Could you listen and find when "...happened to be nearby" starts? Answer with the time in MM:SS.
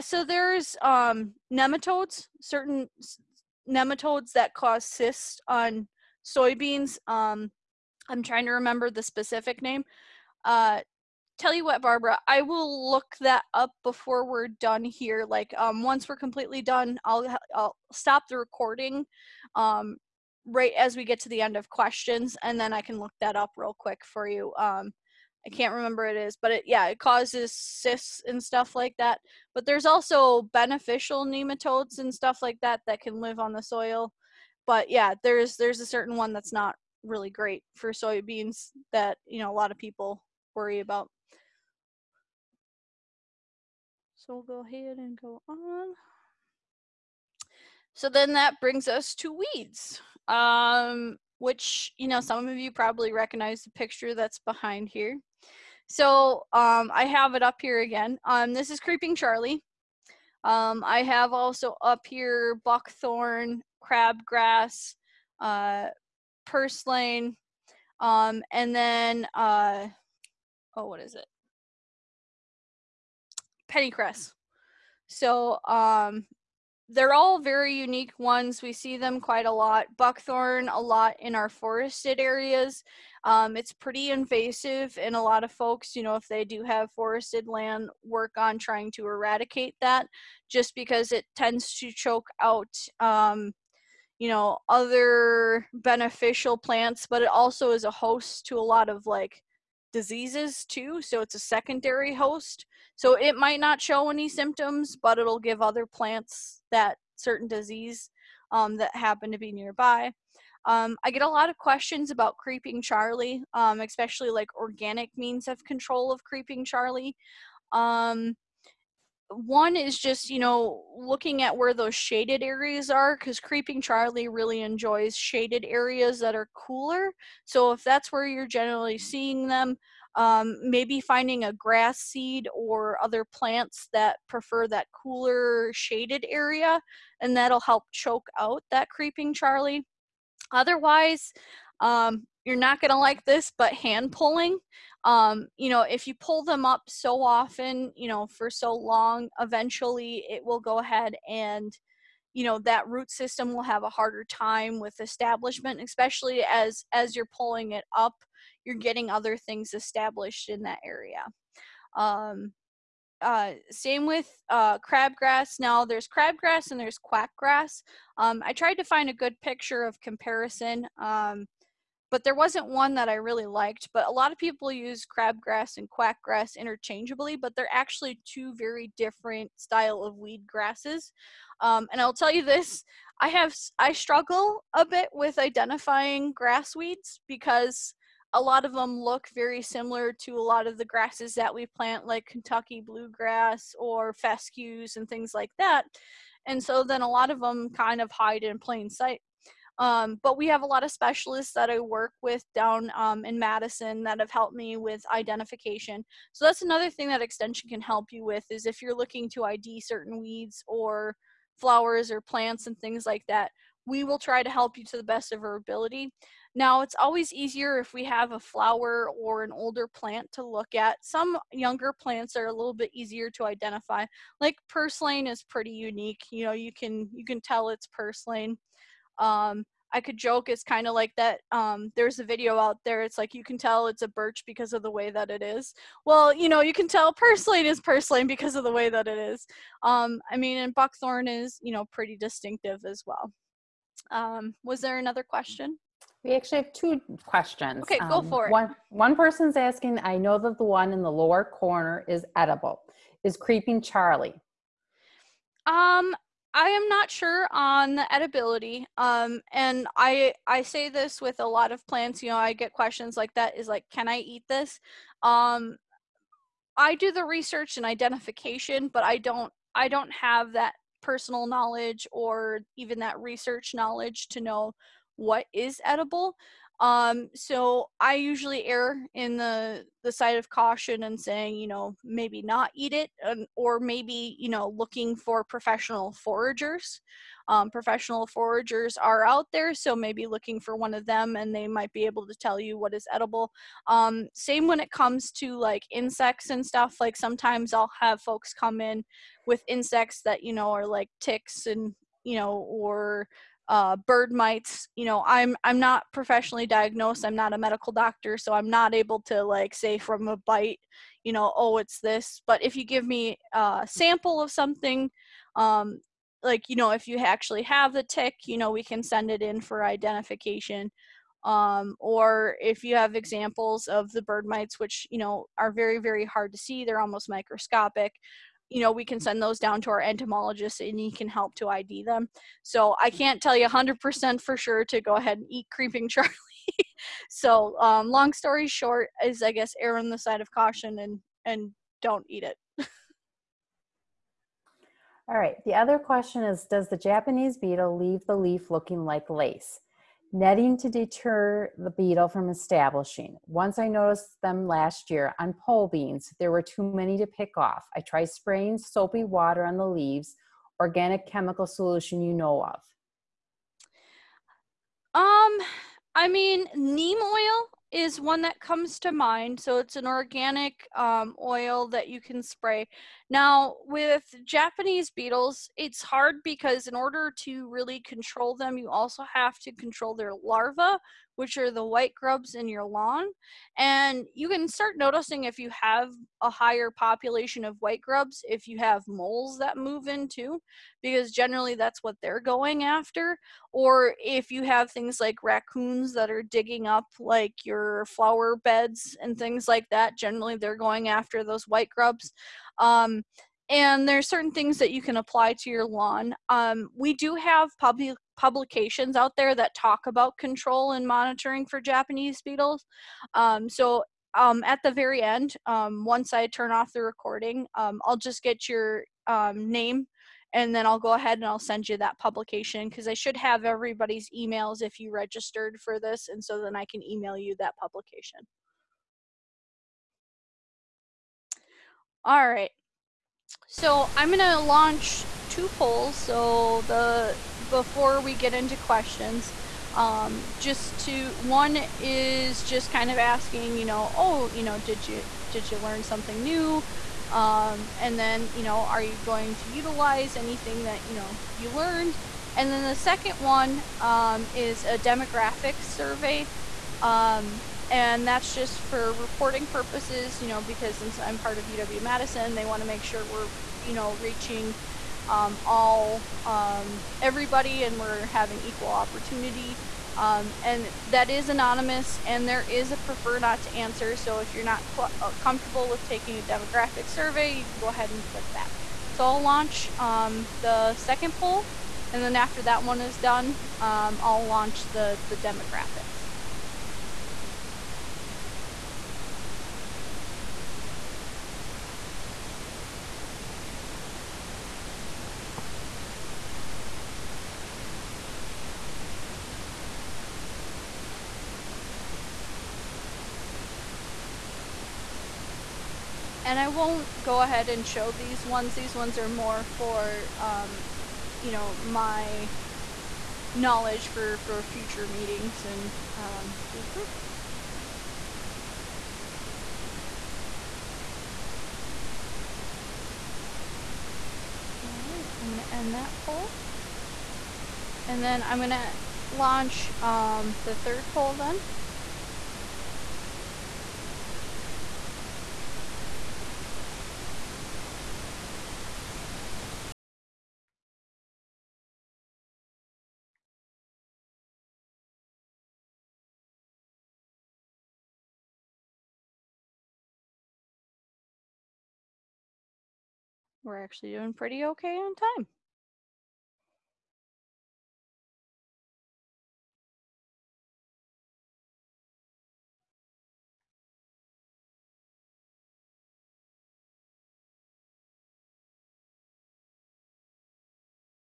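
01:48.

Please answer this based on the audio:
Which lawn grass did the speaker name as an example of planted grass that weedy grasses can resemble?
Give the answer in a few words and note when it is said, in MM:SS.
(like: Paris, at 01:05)
Kentucky bluegrass, at 03:12.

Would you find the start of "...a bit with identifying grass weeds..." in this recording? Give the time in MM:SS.
03:04.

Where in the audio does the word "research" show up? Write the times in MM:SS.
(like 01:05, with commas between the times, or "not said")
04:27, 04:33.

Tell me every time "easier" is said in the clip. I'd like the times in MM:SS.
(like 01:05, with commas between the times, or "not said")
03:37, 03:42.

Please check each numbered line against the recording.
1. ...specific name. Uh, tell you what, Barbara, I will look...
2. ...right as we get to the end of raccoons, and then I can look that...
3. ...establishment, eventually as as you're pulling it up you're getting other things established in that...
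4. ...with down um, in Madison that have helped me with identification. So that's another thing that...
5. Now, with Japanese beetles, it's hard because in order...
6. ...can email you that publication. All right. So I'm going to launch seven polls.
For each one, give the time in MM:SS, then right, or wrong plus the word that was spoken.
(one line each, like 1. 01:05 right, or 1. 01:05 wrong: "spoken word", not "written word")
1. 00:09 right
2. 00:20 wrong: "questions", not "raccoons"
3. 02:34 wrong: "especially", not "eventually"
4. 03:22 right
5. 06:13 right
6. 07:06 wrong: "two", not "seven".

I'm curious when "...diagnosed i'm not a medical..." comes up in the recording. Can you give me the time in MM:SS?
05:06.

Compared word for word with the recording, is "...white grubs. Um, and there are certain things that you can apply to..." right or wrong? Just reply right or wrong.
right.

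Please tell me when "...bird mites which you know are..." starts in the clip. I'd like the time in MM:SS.
05:24.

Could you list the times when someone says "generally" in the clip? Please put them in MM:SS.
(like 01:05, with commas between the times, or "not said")
02:08, 06:31, 06:40.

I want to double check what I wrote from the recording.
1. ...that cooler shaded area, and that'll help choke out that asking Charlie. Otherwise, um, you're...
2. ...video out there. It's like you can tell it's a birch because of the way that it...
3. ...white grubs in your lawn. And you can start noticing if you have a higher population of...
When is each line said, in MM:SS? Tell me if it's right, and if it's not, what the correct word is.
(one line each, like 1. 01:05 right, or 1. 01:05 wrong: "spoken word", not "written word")
1. 02:14 wrong: "creeping", not "asking"
2. 03:52 right
3. 06:21 right.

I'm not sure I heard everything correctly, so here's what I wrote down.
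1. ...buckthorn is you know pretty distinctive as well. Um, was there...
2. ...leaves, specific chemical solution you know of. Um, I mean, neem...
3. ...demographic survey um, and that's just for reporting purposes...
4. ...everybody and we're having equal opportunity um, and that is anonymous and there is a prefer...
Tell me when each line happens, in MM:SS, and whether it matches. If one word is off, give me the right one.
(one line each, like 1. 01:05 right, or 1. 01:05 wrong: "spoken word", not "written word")
1. 04:00 right
2. 05:59 wrong: "organic", not "specific"
3. 07:34 right
4. 07:47 right.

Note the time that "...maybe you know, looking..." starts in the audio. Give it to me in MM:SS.
04:43.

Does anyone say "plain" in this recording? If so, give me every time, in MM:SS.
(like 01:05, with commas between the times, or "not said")
03:18.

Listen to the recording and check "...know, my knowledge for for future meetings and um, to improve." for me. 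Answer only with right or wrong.
right.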